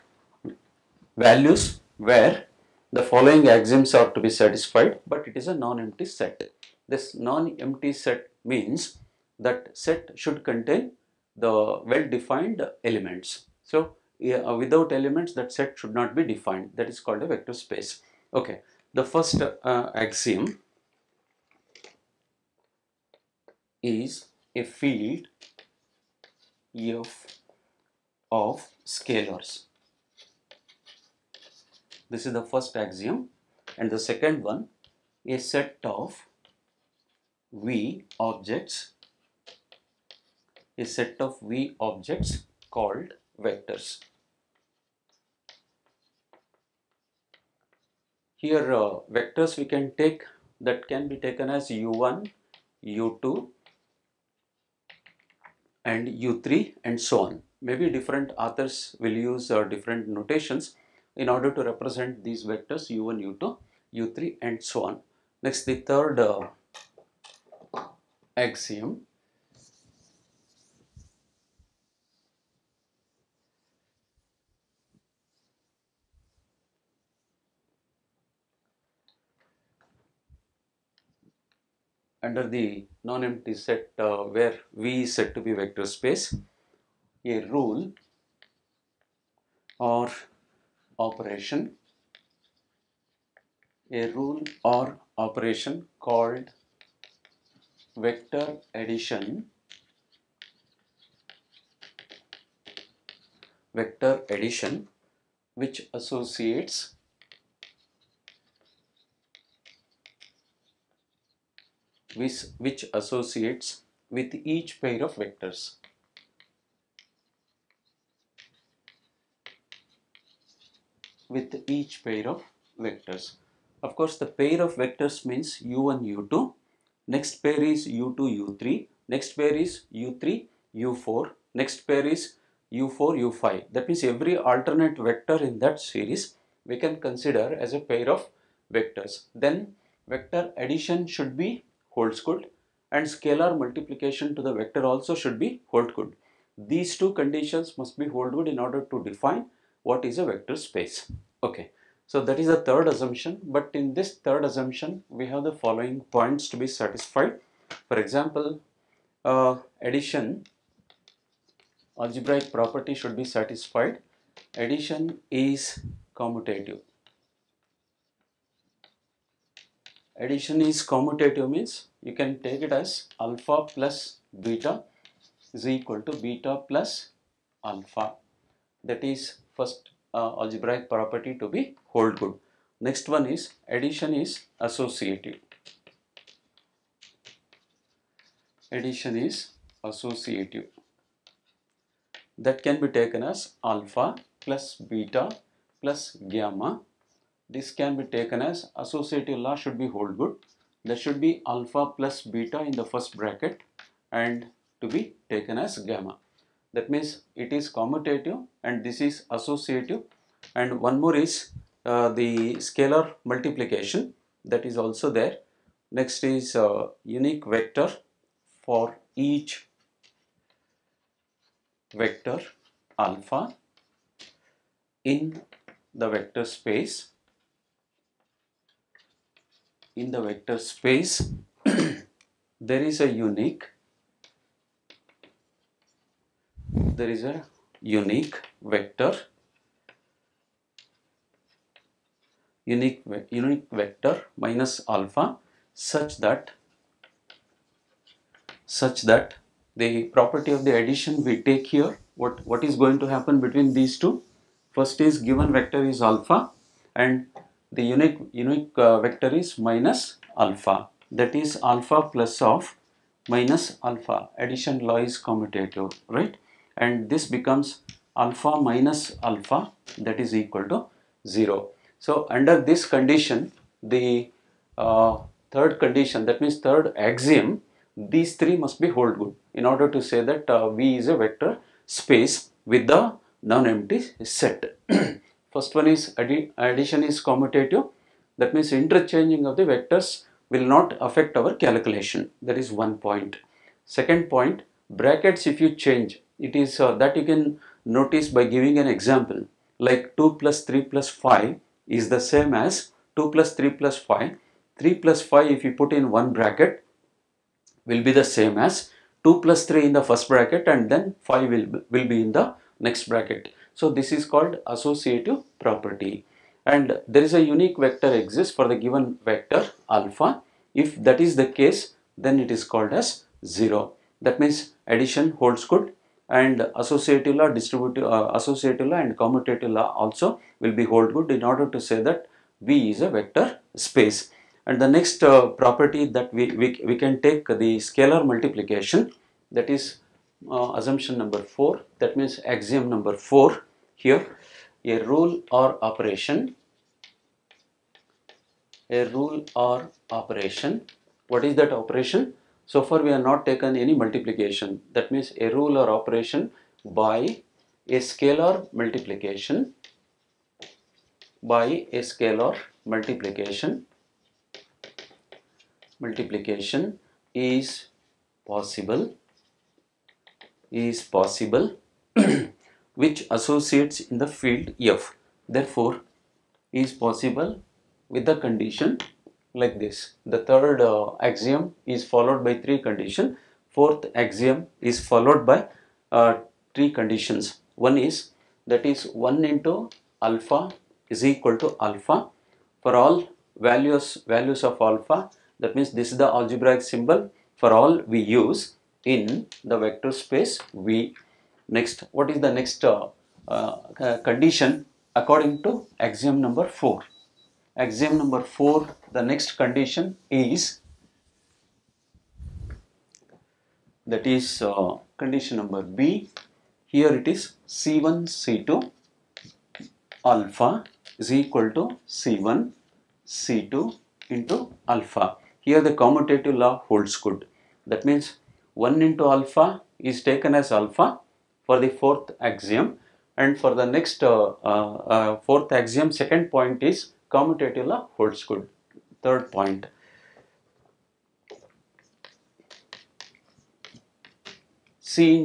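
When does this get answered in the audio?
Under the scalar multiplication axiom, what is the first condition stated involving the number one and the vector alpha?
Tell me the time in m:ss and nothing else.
6:29.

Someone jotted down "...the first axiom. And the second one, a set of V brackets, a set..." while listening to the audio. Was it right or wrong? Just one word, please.
wrong.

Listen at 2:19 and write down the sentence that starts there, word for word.
Then vector addition should be good, and scalar multiplication to the vector also should be hold good.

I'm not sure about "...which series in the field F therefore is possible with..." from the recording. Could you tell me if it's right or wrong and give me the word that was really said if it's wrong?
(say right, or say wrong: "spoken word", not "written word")
wrong: "associates", not "series".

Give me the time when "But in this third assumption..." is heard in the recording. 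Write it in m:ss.
2:33.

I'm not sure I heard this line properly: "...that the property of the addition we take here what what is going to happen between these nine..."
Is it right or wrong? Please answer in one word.
wrong.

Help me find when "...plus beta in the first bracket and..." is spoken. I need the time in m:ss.
3:21.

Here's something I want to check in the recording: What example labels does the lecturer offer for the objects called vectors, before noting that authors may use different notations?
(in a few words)
u1, u2 and u3.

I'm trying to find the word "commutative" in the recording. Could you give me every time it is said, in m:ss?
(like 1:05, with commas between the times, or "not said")
2:46, 2:50, 3:27, 4:25, 4:47, 5:29, 7:06, 7:17.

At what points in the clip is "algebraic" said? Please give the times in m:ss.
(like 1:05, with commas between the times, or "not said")
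2:41, 3:00, 6:36.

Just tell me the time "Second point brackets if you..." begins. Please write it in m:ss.
4:53.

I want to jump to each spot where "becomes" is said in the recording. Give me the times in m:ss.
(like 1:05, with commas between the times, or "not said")
4:27.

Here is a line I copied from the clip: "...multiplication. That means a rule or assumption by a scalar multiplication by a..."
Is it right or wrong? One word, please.
wrong.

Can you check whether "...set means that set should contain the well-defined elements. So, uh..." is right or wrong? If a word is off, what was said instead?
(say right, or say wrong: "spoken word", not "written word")
right.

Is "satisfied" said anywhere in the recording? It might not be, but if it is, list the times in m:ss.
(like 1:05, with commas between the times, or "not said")
0:04, 2:36, 2:43.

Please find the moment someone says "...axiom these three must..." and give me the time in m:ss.
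4:36.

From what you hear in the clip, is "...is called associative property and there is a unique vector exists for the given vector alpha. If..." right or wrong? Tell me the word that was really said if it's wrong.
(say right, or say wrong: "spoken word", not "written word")
right.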